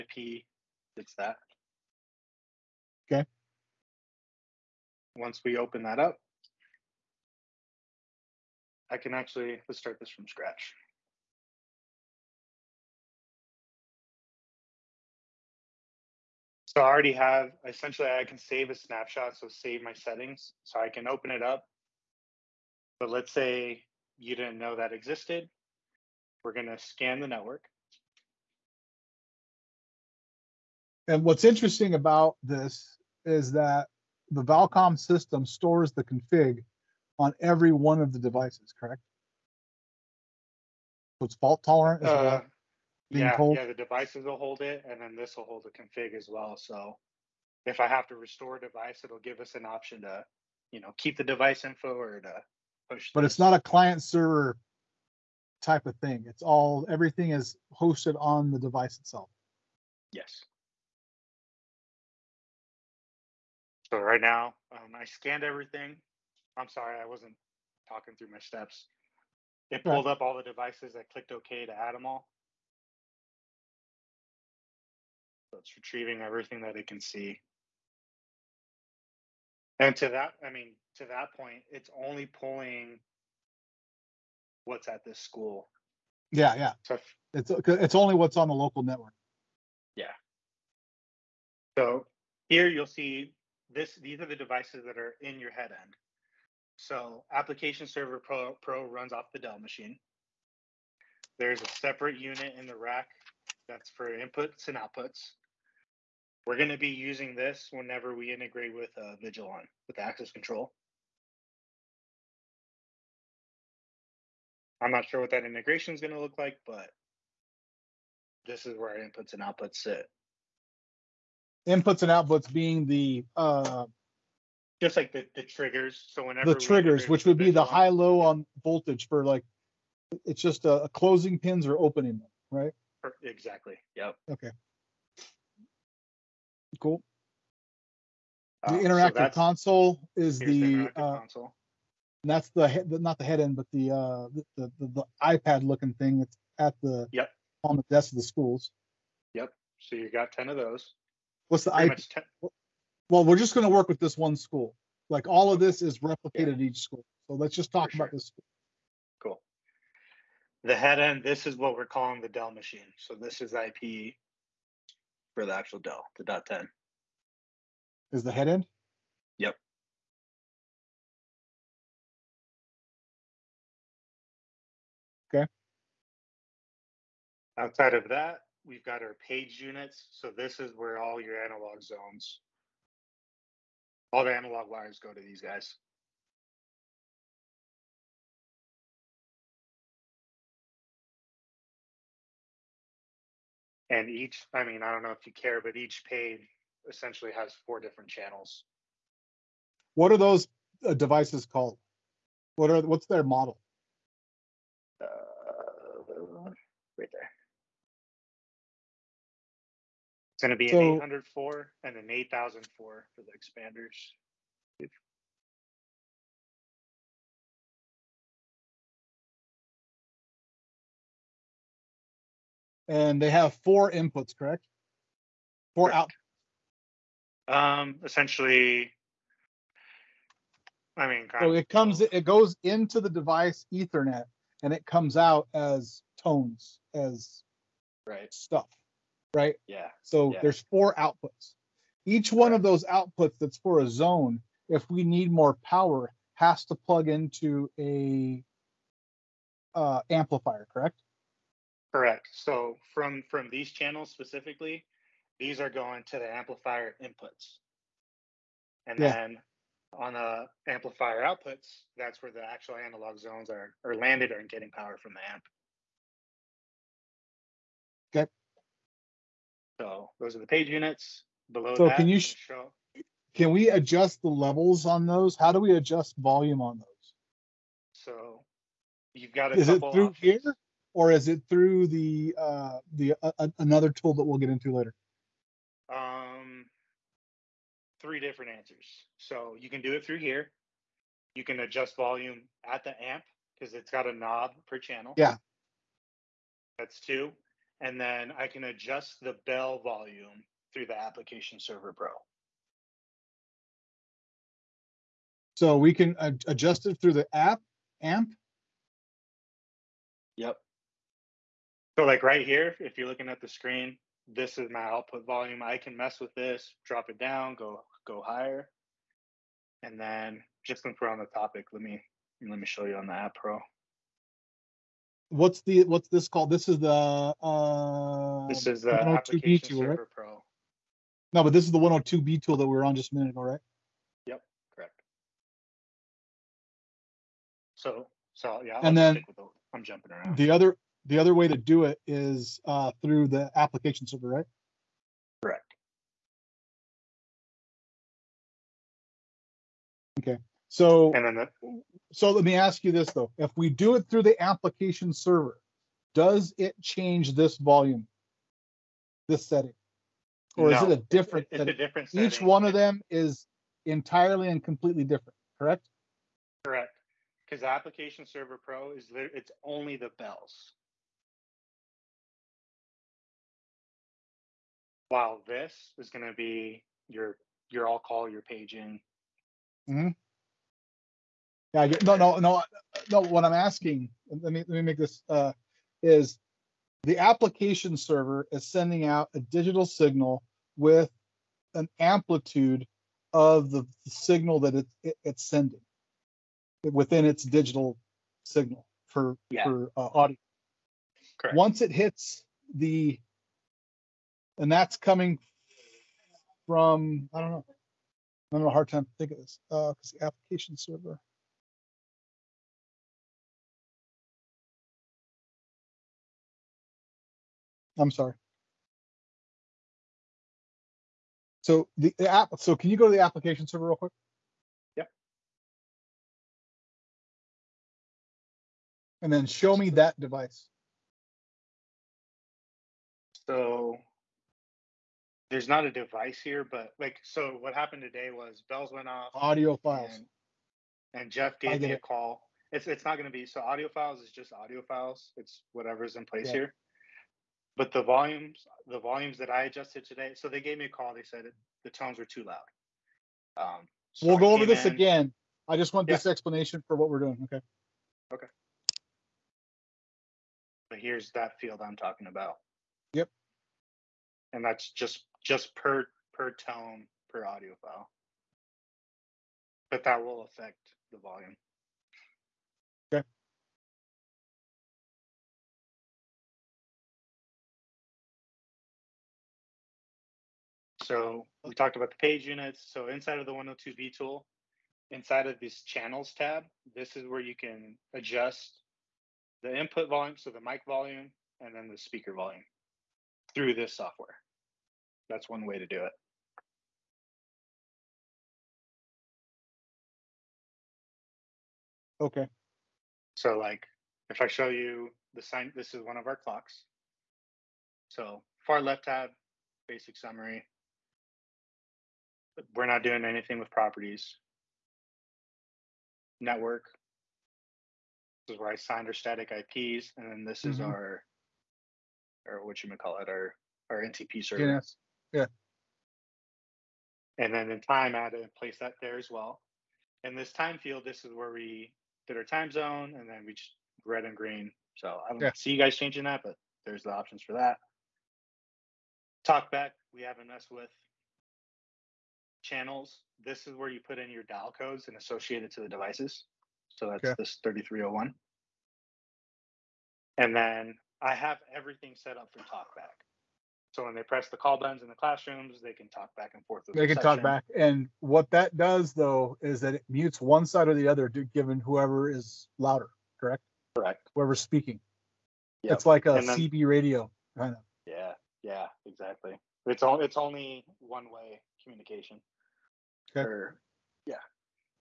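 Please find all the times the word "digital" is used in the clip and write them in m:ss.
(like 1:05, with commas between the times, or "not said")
6:29, 6:37.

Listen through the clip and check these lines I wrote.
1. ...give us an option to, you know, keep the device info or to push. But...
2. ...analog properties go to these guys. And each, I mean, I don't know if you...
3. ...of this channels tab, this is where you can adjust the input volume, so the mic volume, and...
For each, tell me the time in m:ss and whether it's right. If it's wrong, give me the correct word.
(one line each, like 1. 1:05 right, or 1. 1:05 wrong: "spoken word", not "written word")
1. 0:49 right
2. 3:04 wrong: "wires", not "properties"
3. 8:05 right.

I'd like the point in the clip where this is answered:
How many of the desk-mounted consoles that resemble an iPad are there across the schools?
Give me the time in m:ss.
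2:30.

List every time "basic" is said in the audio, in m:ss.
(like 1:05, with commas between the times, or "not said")
8:29.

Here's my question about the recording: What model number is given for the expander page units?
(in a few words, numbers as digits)
8004.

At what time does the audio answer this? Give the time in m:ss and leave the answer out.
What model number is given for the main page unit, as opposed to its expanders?
3:30.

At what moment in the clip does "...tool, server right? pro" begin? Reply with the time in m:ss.
5:29.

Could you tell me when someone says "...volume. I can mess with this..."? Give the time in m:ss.
5:15.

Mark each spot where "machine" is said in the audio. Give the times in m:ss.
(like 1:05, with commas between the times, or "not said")
1:39, 2:42.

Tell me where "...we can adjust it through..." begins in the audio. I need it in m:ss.
5:05.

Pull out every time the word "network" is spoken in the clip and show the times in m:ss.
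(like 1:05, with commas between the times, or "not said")
0:27, 1:28, 8:36.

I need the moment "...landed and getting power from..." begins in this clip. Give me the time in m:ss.
4:23.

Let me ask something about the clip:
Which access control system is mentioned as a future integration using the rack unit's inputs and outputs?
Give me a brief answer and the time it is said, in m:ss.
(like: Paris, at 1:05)
Vigilon, at 1:49.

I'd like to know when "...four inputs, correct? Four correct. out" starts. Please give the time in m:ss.
3:43.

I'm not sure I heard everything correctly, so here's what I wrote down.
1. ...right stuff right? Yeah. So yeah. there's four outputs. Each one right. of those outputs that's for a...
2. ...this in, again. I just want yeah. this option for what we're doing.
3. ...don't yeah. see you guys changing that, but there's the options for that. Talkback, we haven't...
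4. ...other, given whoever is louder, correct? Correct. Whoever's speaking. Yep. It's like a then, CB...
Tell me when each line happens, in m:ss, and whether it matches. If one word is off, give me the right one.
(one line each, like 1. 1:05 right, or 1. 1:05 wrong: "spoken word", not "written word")
1. 3:58 right
2. 7:34 wrong: "explanation", not "option"
3. 8:55 right
4. 9:21 right.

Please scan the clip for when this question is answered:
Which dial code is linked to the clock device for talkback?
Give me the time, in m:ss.
9:07.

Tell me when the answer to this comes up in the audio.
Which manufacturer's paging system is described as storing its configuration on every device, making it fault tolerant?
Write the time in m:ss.
0:34.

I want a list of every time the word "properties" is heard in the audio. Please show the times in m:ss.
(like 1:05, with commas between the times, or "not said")
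8:33.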